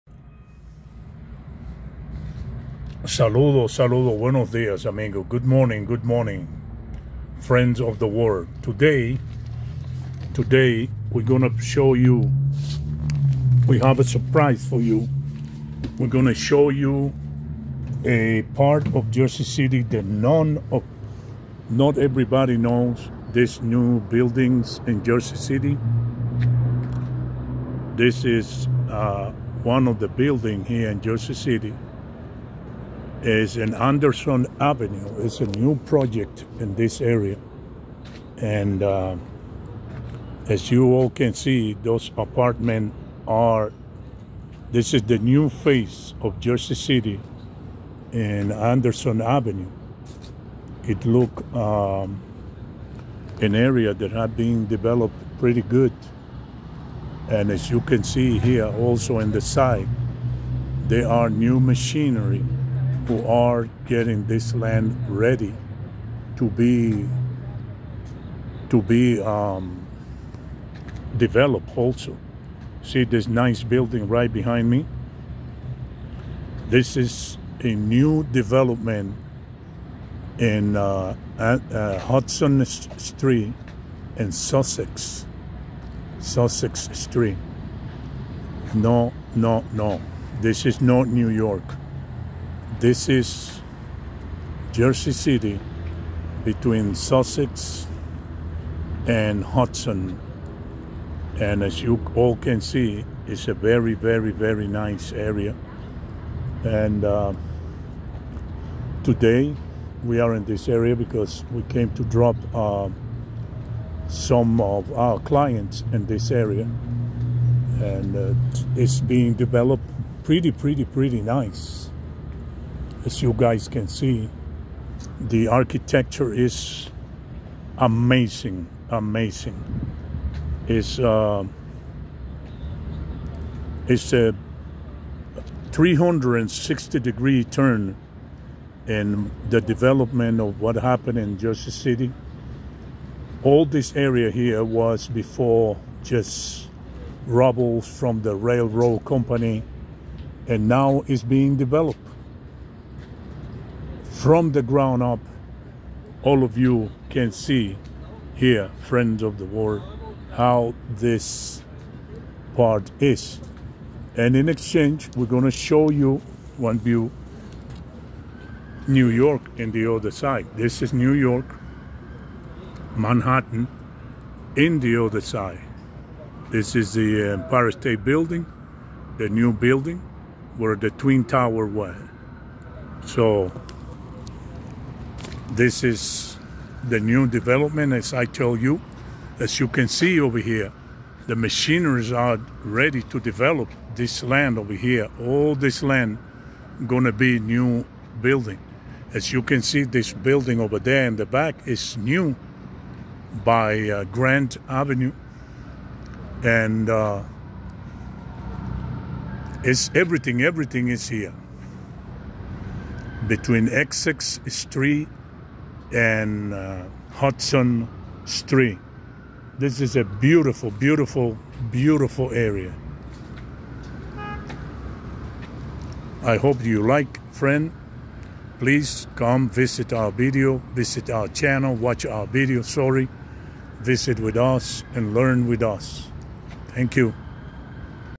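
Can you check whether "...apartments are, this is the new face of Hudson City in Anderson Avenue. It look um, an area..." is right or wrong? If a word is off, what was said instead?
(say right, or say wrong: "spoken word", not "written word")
wrong: "Jersey", not "Hudson".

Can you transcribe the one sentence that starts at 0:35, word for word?
It's a new project in this area.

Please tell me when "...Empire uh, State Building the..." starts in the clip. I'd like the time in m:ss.
2:57.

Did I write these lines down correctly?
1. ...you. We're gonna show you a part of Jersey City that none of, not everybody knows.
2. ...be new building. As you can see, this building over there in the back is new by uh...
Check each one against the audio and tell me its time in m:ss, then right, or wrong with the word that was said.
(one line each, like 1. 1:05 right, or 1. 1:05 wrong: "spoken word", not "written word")
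1. 0:14 right
2. 3:17 right.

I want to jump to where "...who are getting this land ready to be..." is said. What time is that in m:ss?
1:03.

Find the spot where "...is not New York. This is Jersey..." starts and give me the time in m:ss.
1:30.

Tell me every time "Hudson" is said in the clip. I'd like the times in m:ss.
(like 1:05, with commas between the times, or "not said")
1:21, 1:39, 3:37.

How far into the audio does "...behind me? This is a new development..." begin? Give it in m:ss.
1:14.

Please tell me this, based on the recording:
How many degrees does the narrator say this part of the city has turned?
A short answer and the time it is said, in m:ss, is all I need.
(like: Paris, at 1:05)
360, at 2:15.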